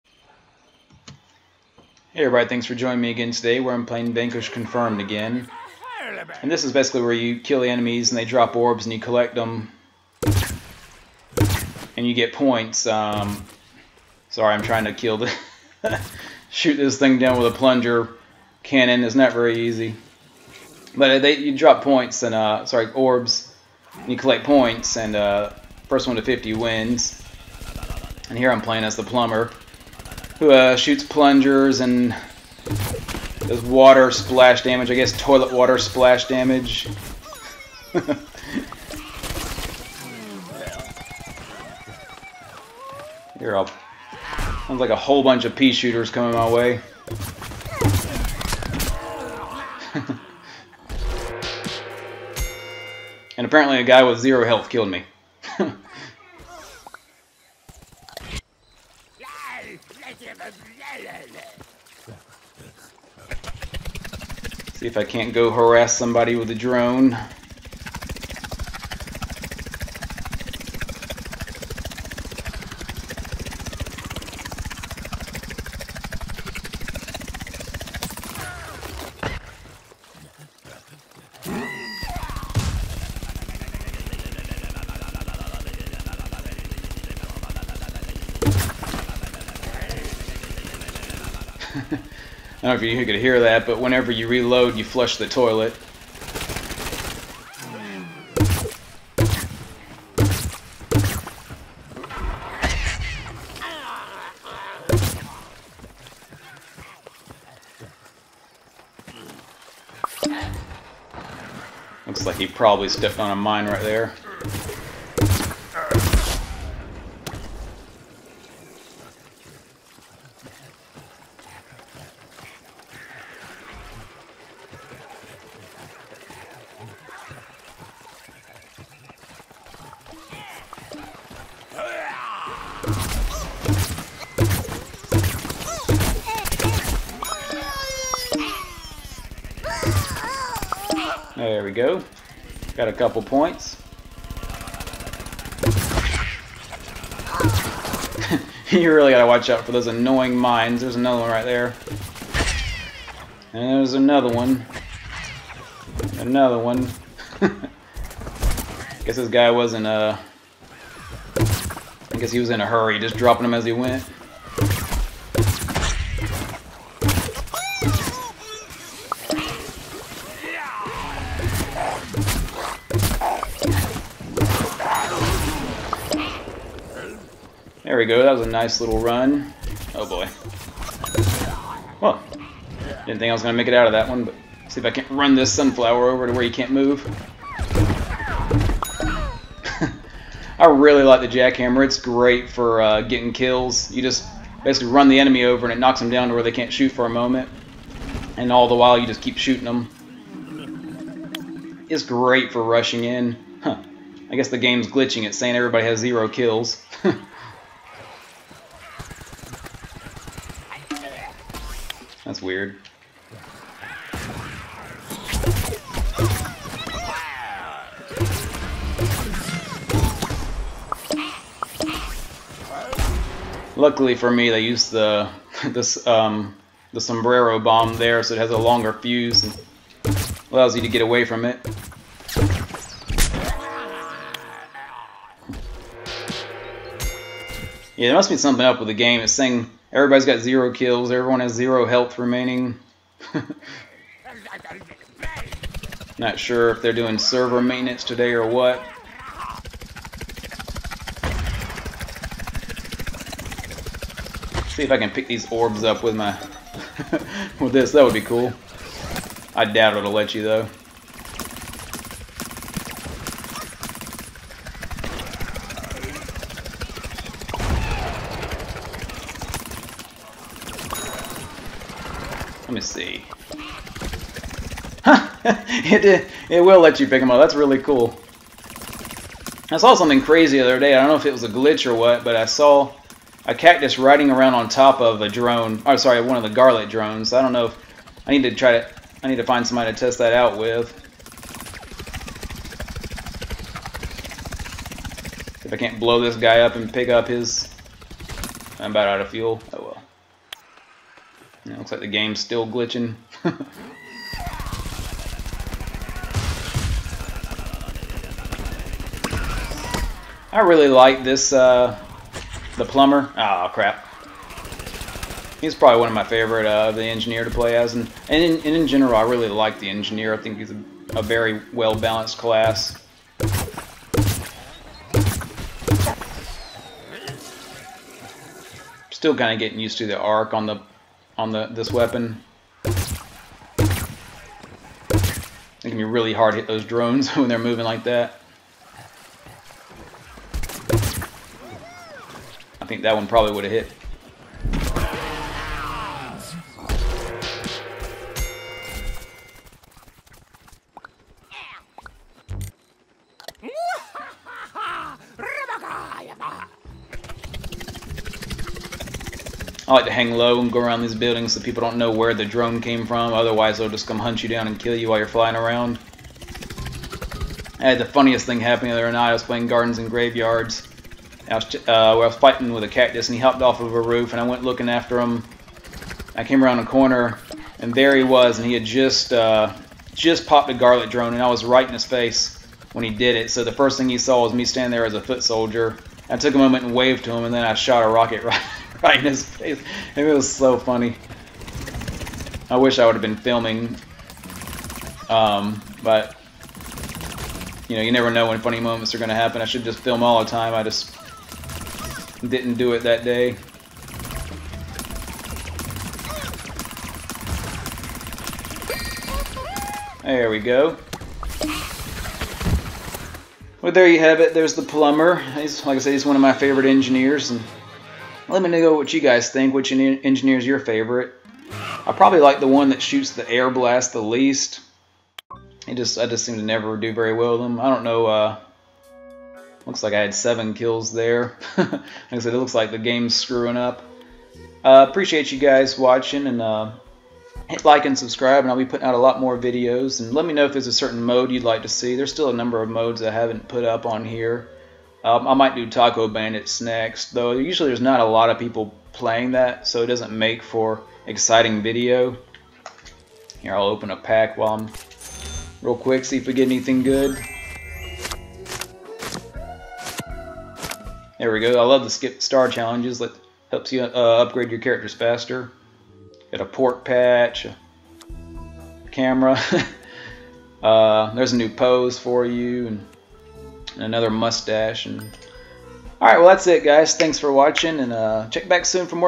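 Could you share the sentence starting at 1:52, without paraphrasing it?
Looks like he probably stepped on a mine right there.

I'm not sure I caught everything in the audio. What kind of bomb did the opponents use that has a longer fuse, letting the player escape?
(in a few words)
sombrero bomb.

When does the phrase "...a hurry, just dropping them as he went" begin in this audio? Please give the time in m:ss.
2:42.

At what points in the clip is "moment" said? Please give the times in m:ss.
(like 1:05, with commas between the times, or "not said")
3:17, 6:26, 6:38.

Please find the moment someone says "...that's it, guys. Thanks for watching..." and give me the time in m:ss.
7:56.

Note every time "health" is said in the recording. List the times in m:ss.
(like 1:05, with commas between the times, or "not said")
0:54, 4:01.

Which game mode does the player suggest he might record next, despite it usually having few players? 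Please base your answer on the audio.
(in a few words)
Taco Bandits.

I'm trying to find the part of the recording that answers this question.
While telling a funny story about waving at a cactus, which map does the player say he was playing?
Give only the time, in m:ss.
6:09.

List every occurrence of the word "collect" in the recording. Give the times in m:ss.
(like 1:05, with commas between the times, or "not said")
0:08, 0:24.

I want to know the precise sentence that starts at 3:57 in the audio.
Yeah, there must be something up with the game.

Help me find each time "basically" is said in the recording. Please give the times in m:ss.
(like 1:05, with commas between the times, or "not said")
0:06, 3:14.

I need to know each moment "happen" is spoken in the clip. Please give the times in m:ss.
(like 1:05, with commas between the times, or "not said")
6:08, 6:39.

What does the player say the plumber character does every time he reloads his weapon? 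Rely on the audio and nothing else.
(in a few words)
flush the toilet.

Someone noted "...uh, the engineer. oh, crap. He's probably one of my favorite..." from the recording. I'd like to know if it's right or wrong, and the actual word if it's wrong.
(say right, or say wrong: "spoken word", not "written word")
wrong: "plumber", not "engineer".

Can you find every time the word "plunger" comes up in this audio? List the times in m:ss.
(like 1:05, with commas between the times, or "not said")
0:17, 0:31.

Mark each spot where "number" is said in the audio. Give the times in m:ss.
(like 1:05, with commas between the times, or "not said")
7:22.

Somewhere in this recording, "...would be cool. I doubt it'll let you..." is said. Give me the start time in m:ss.
4:18.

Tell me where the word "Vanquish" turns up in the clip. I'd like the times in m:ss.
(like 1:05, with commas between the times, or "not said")
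0:04.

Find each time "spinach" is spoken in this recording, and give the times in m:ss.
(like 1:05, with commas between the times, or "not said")
not said.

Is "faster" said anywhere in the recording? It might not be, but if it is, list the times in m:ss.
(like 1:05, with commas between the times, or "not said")
7:45.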